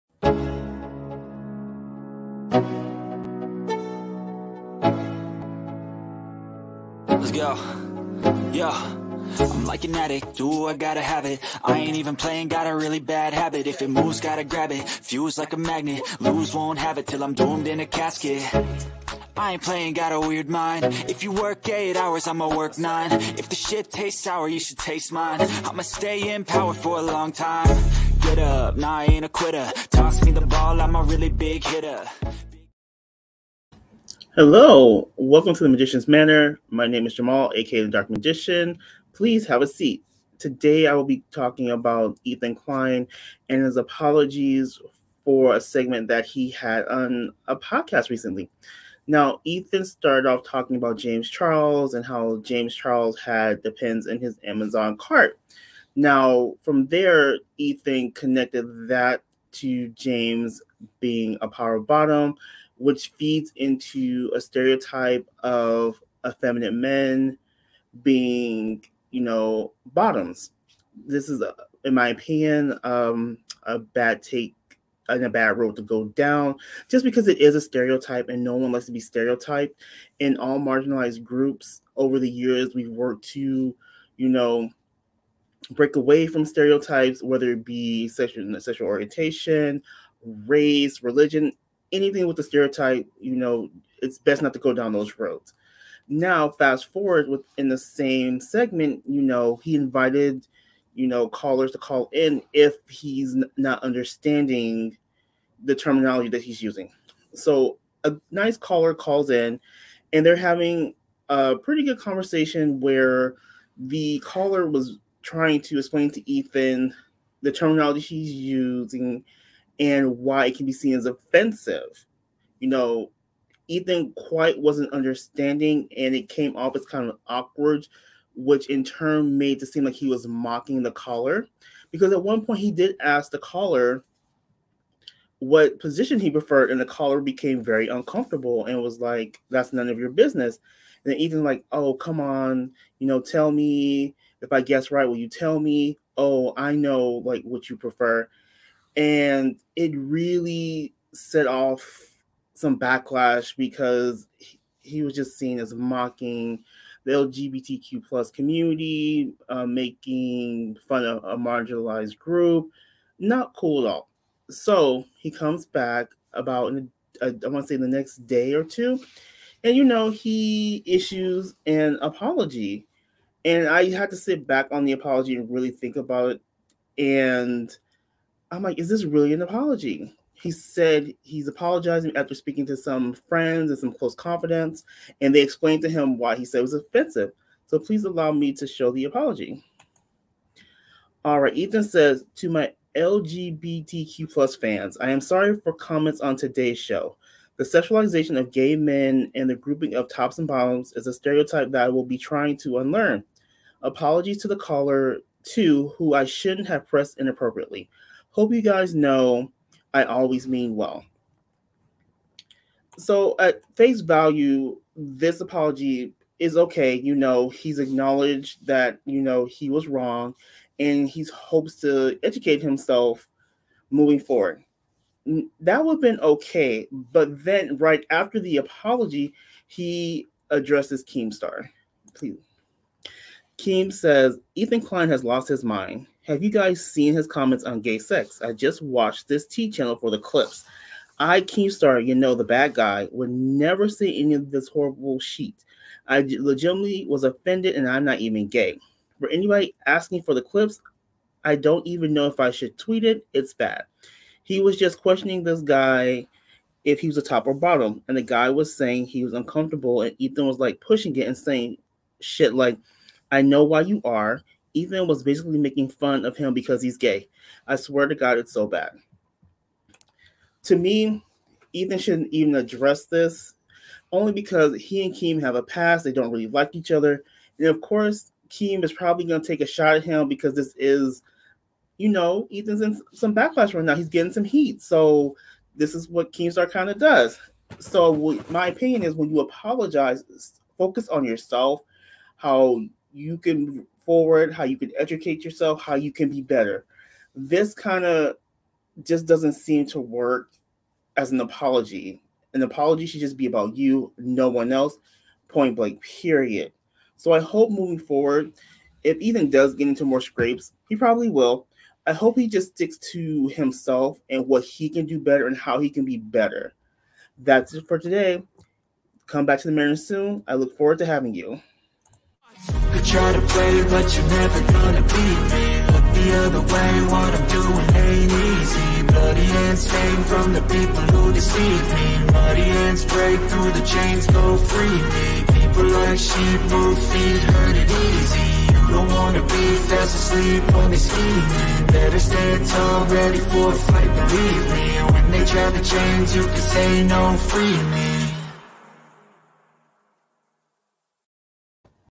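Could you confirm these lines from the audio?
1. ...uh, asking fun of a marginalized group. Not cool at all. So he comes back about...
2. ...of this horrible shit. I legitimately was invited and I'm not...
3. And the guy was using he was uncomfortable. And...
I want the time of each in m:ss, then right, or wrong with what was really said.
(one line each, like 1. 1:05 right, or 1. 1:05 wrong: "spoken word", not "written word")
1. 2:39 wrong: "making", not "asking"
2. 4:04 wrong: "offended", not "invited"
3. 4:18 wrong: "saying", not "using".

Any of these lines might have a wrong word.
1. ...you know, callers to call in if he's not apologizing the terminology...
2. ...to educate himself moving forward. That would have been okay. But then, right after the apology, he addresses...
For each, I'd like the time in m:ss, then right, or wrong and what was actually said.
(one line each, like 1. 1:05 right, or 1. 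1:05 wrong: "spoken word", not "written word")
1. 1:40 wrong: "understanding", not "apologizing"
2. 3:41 right.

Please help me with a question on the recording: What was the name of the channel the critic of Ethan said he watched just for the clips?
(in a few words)
T channel.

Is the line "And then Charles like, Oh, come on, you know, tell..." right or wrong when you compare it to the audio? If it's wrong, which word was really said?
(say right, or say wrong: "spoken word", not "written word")
wrong: "Ethan", not "Charles".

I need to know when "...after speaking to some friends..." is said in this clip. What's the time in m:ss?
3:02.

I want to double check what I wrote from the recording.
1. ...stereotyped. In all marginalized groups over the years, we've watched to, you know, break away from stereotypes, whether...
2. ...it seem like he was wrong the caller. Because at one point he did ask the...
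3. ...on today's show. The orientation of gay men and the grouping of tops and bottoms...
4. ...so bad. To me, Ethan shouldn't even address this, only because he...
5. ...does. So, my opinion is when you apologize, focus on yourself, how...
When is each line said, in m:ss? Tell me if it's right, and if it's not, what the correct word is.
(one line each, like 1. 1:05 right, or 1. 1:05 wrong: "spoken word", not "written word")
1. 1:18 wrong: "worked", not "watched"
2. 2:09 wrong: "mocking", not "wrong"
3. 3:16 wrong: "sexualization", not "orientation"
4. 4:28 right
5. 4:46 right.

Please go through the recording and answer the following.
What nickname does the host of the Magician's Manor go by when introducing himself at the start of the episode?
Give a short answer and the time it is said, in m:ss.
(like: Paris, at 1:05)
the Dark Magician, at 0:37.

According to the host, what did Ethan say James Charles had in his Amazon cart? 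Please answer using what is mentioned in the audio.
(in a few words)
pins.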